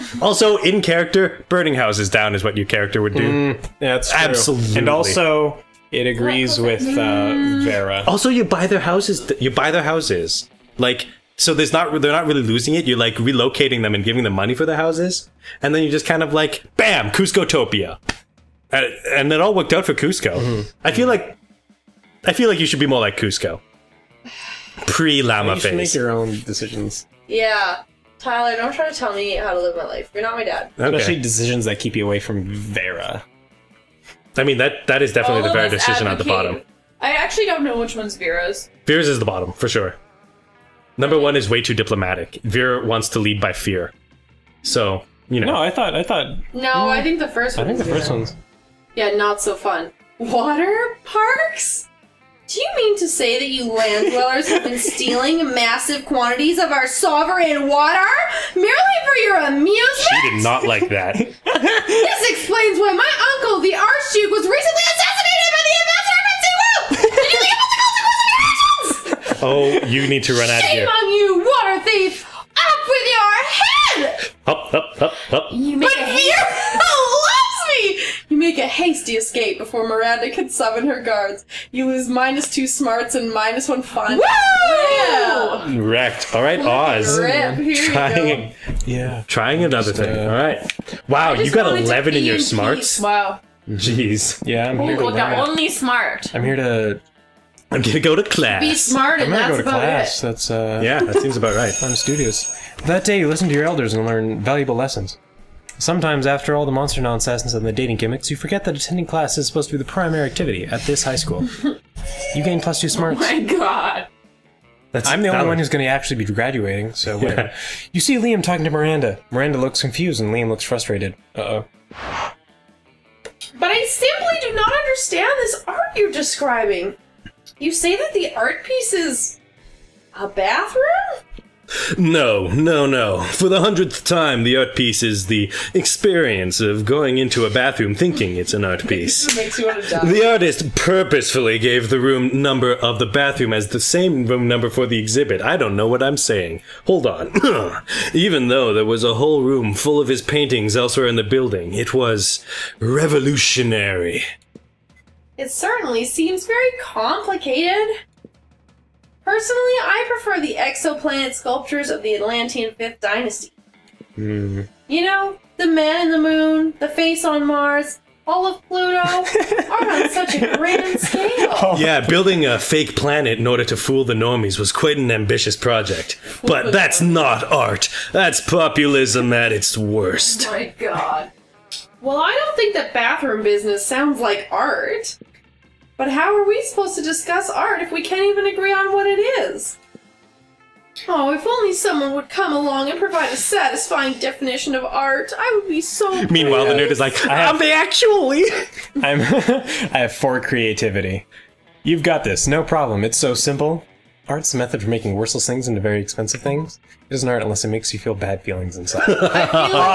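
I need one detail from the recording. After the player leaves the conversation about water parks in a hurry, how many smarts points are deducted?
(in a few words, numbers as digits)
2.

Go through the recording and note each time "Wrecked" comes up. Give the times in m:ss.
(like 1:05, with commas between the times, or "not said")
1:25.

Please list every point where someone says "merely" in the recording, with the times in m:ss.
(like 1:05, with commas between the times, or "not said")
0:58.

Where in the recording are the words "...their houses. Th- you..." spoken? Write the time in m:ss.
0:08.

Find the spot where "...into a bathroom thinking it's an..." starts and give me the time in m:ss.
2:17.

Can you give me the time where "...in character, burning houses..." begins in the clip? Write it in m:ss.
0:00.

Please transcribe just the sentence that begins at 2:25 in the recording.
I don't know what I'm saying.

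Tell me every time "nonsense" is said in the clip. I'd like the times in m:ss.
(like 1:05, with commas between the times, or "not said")
1:47.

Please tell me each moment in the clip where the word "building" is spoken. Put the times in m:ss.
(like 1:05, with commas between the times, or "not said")
2:31, 2:52.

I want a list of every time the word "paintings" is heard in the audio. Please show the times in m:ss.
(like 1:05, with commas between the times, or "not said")
2:30.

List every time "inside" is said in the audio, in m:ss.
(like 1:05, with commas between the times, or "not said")
3:28.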